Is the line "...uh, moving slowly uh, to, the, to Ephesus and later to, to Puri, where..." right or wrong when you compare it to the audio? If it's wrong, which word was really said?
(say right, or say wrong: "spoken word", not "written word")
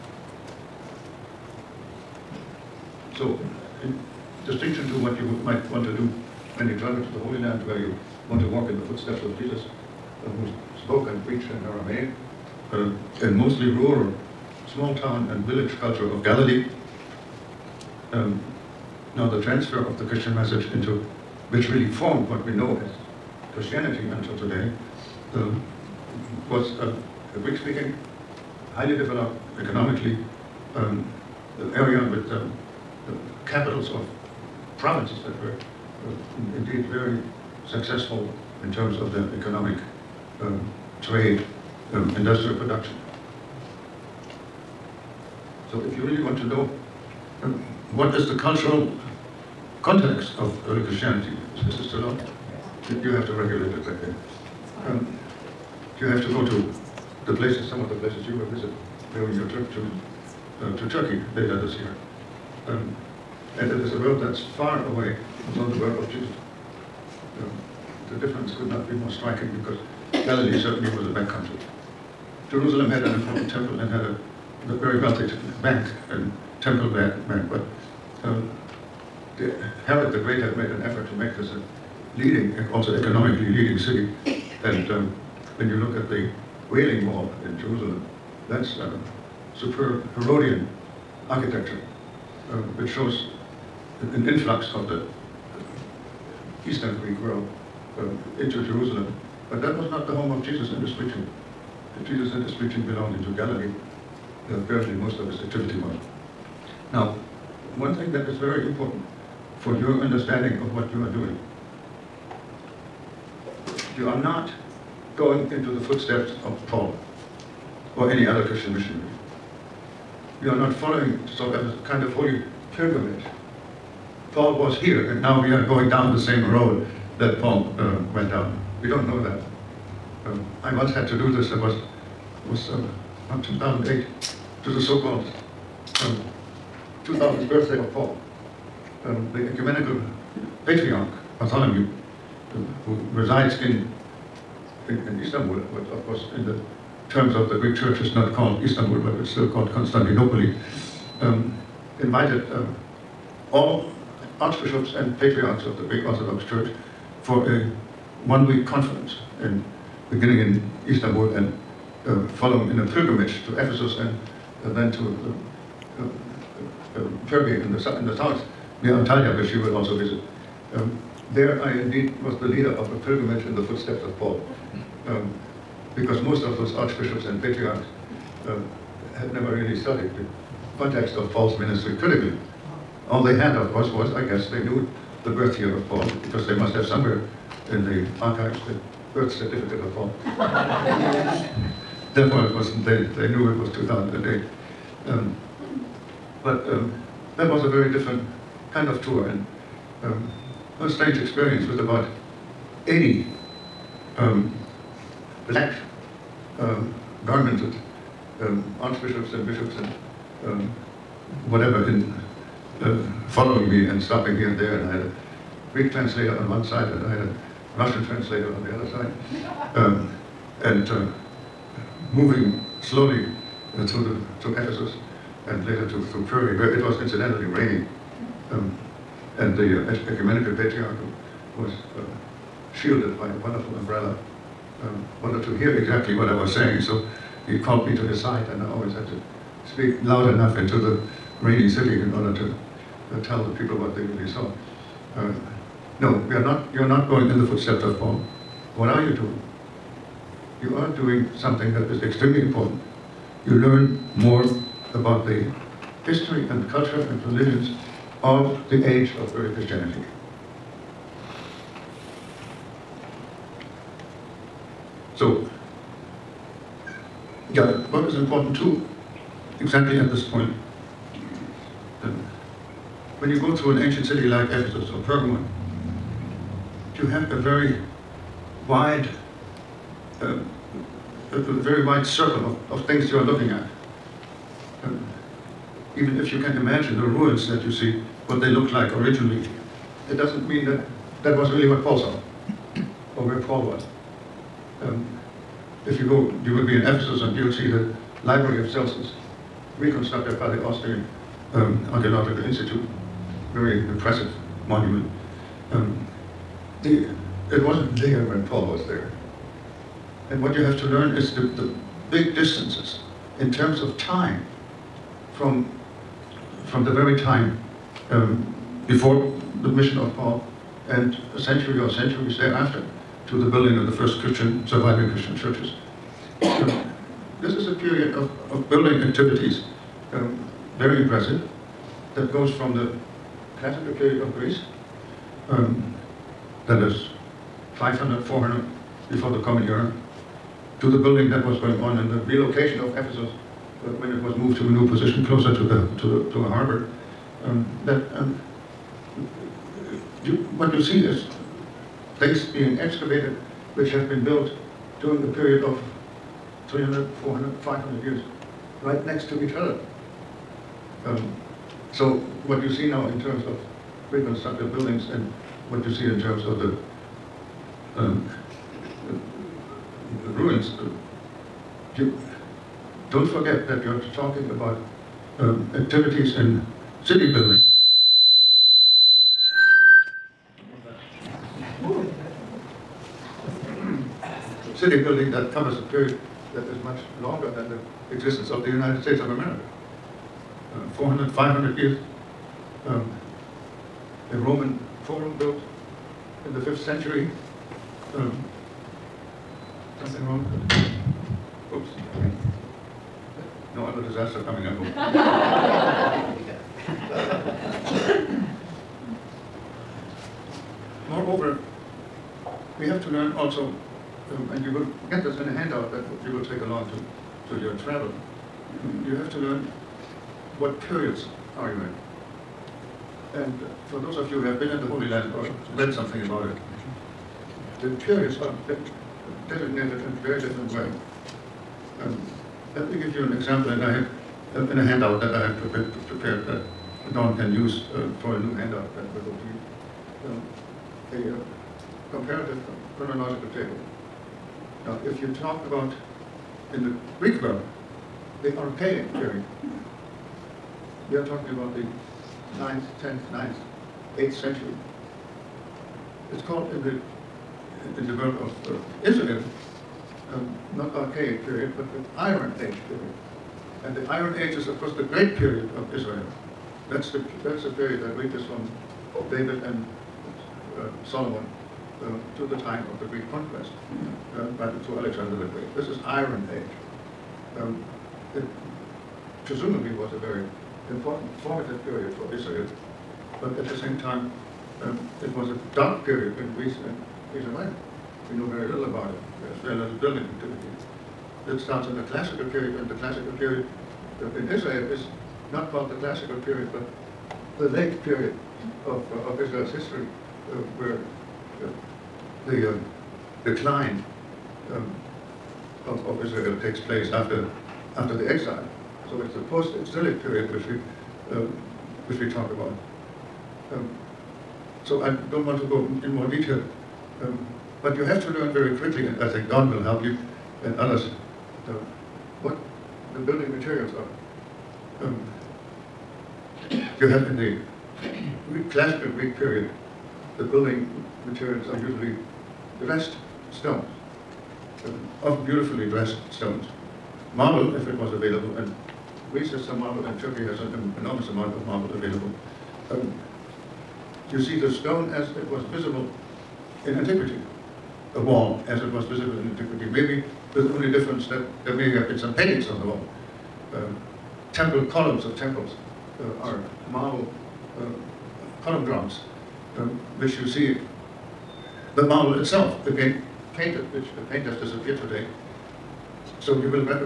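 right.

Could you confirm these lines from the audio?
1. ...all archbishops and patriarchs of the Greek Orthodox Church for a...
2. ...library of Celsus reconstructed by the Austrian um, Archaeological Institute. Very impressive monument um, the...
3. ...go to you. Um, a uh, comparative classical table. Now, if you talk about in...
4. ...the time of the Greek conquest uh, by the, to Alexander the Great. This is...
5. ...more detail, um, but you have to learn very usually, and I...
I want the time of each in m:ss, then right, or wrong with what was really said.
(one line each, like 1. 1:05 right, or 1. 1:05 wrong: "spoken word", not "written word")
1. 2:33 right
2. 4:58 right
3. 7:19 wrong: "chronological", not "classical"
4. 7:52 right
5. 8:36 wrong: "quickly", not "usually".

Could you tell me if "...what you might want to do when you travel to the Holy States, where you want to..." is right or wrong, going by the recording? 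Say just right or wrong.
wrong.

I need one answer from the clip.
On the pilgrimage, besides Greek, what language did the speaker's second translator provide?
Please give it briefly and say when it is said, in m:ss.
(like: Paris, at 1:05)
Russian, at 3:37.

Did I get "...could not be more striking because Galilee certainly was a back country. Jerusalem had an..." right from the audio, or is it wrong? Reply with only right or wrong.
right.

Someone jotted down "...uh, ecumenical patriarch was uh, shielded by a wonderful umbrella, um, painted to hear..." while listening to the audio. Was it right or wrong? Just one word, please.
wrong.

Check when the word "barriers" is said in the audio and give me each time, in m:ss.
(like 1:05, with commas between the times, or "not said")
not said.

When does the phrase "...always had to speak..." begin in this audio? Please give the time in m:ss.
3:58.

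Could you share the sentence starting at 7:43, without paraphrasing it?
And the Iron Age is, of course, the great period of Israel.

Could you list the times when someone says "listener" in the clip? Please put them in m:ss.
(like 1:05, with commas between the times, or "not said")
not said.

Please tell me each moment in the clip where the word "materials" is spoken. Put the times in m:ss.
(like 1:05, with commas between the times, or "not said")
8:43, 8:51.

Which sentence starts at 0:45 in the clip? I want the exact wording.
So if you really want to know um, what is the cultural context of early Christianity, is Mr.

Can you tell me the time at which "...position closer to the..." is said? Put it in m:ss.
5:44.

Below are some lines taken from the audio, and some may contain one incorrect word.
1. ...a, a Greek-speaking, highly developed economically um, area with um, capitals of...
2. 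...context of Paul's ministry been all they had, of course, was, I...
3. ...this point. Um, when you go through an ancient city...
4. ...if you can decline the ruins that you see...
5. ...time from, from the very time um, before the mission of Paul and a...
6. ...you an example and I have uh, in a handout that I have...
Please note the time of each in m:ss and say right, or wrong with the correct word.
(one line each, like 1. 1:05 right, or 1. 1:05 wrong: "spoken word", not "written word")
1. 0:26 right
2. 3:00 right
3. 4:30 right
4. 4:46 wrong: "imagine", not "decline"
5. 5:13 right
6. 7:13 right.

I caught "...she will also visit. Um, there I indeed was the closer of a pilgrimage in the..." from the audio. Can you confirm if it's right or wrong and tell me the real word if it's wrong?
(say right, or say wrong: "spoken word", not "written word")
wrong: "leader", not "closer".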